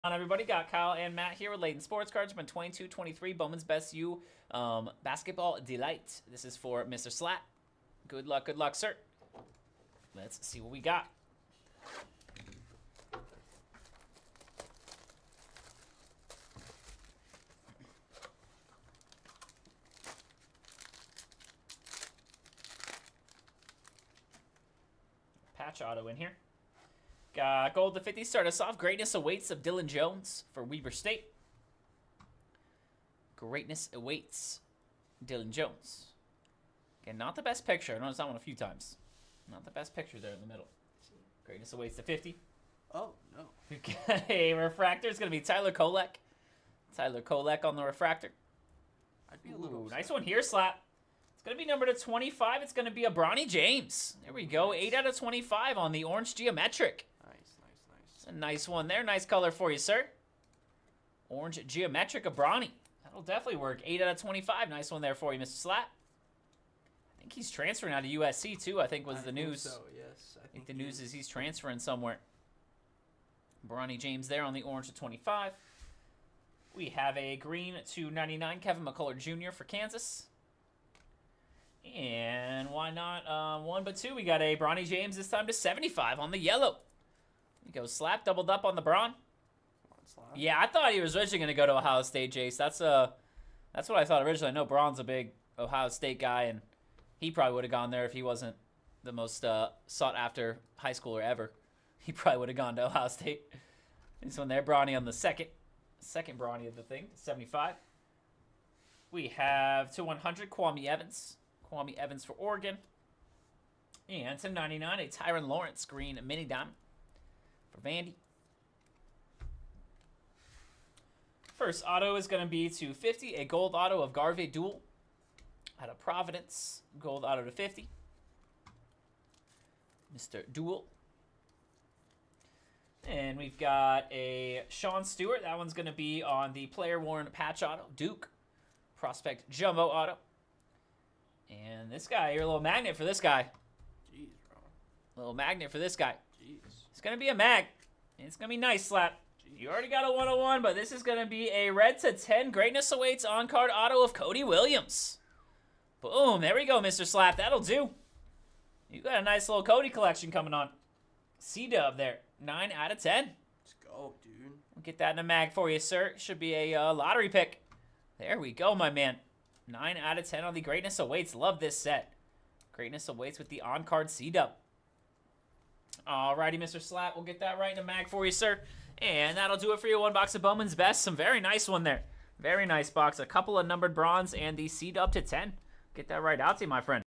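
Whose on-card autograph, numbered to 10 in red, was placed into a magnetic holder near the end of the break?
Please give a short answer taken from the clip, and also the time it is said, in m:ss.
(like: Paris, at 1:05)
Cody Williams, at 2:34.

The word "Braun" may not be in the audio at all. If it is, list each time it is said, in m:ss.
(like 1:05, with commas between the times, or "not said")
1:28, 1:34.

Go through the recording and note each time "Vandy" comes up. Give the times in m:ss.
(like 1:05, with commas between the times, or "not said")
1:57.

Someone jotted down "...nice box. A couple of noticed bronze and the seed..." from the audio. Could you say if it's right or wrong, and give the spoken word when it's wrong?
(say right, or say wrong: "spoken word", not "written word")
wrong: "numbered", not "noticed".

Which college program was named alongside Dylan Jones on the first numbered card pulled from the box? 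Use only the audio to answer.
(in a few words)
Weber State.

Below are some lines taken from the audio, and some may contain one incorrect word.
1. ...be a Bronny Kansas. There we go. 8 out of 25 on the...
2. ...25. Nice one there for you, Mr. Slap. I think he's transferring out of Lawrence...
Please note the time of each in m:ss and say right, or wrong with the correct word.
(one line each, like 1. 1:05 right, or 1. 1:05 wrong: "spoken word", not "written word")
1. 0:52 wrong: "James", not "Kansas"
2. 1:04 wrong: "USC", not "Lawrence".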